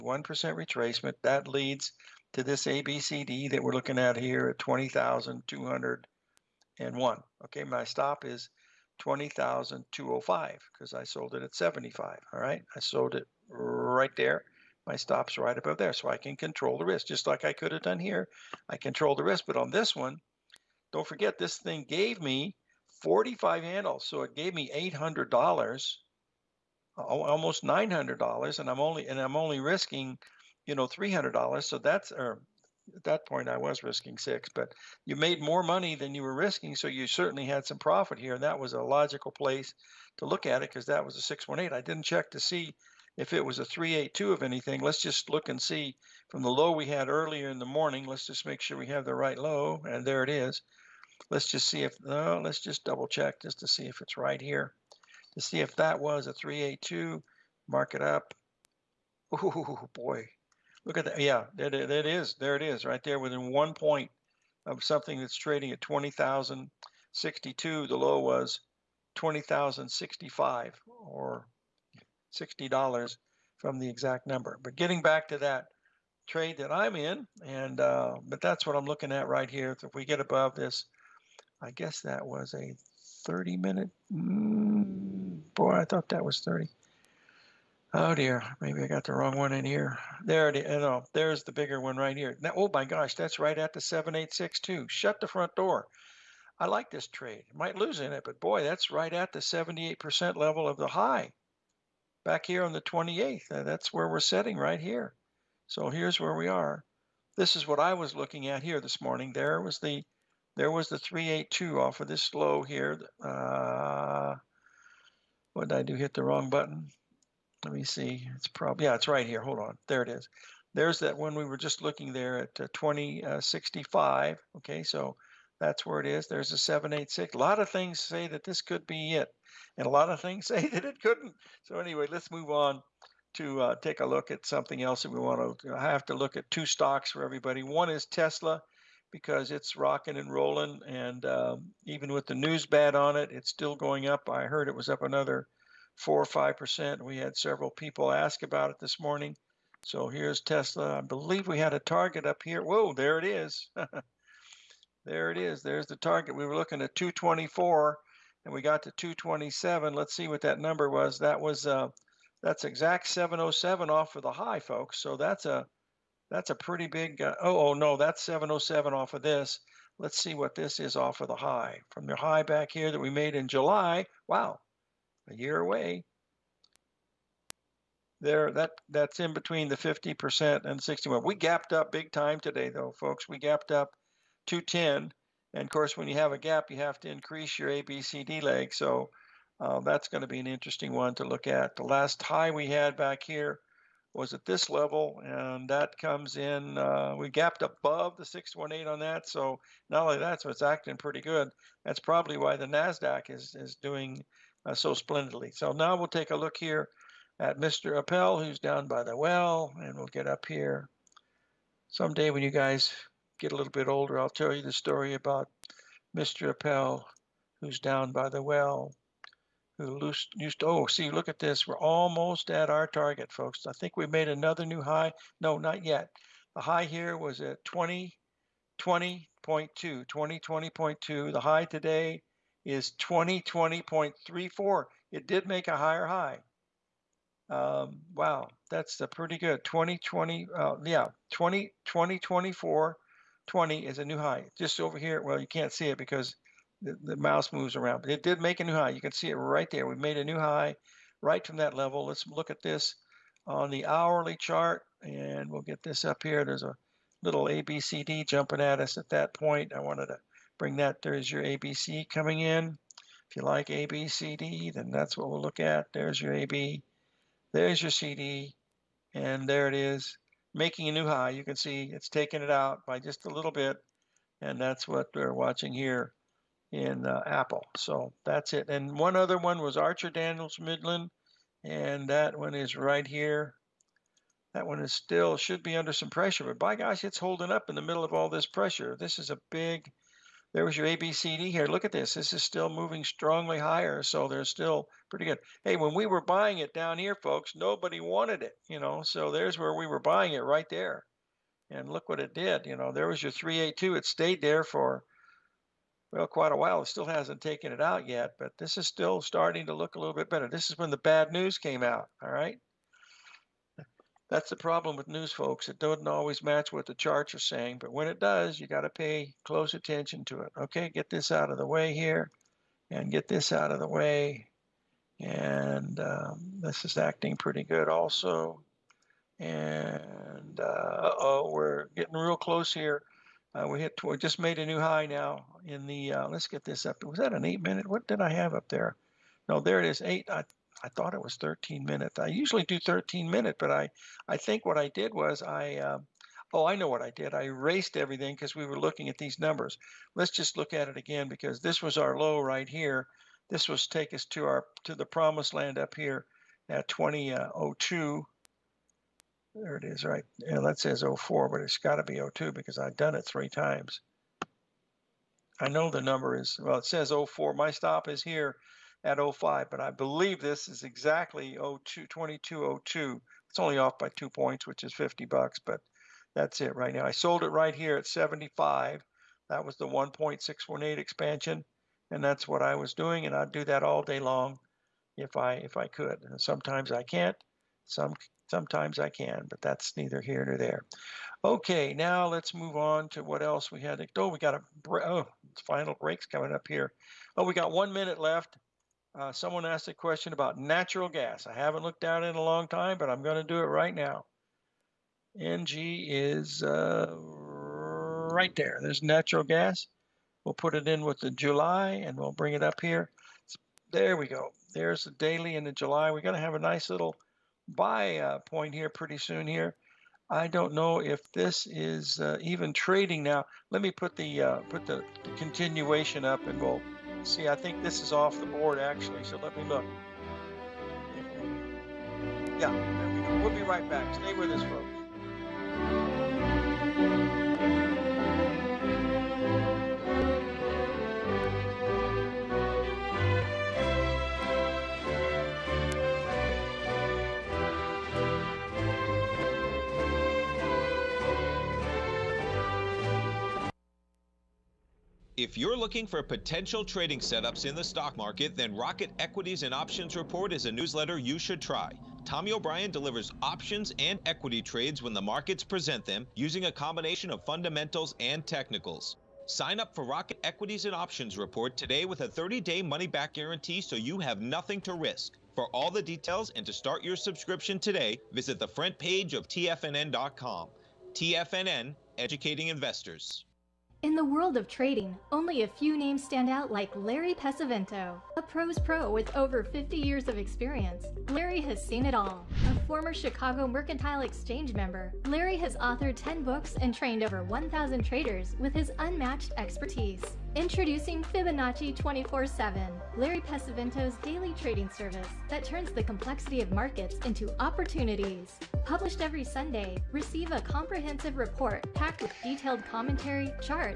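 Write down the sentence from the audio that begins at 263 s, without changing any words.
If you like ABCD, then that's what we'll look at.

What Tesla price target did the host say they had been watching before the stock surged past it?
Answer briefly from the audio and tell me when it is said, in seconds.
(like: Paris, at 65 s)
224, at 156 s.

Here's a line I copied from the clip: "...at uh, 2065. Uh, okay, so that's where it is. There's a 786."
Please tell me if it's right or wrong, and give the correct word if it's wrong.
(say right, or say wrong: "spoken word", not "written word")
right.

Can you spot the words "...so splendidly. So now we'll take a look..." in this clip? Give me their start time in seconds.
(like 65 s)
204 s.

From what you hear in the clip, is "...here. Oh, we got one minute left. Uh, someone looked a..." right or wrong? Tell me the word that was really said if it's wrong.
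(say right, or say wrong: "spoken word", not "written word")
wrong: "asked", not "looked".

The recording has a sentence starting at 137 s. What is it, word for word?
One is Tesla because it's rocking and rolling.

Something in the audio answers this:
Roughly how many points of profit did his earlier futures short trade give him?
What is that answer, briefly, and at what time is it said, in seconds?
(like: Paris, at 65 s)
45, at 23 s.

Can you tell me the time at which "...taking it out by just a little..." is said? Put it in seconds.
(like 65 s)
272 s.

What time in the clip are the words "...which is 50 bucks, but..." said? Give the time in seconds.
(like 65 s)
374 s.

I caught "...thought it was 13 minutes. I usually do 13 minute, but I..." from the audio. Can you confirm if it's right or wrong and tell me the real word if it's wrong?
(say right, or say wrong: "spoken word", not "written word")
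right.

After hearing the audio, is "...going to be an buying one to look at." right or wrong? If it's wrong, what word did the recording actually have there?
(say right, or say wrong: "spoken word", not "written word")
wrong: "interesting", not "buying".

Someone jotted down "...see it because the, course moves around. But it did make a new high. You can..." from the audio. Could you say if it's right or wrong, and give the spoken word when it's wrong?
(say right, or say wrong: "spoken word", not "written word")
wrong: "mouse", not "course".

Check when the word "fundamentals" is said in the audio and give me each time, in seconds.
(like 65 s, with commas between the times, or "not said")
467 s.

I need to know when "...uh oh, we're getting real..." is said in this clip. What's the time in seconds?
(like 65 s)
330 s.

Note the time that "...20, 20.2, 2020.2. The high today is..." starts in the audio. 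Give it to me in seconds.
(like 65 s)
227 s.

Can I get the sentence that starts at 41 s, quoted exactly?
I didn't check to see if it was a three eight two of anything.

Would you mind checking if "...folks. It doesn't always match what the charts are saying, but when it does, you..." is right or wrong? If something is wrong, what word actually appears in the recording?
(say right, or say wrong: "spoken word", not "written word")
right.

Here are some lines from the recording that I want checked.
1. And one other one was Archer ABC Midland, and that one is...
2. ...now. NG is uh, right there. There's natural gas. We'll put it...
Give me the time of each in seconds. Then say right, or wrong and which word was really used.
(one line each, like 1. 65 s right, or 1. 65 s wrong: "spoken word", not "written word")
1. 278 s wrong: "Daniels", not "ABC"
2. 403 s right.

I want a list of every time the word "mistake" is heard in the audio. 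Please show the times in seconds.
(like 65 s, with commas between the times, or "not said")
not said.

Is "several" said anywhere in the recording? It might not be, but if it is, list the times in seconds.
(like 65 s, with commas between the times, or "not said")
147 s.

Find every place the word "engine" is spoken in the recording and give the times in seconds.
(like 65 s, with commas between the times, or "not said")
not said.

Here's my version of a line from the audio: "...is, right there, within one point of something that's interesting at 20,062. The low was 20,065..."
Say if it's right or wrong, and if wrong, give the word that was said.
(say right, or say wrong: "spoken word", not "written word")
wrong: "trading", not "interesting".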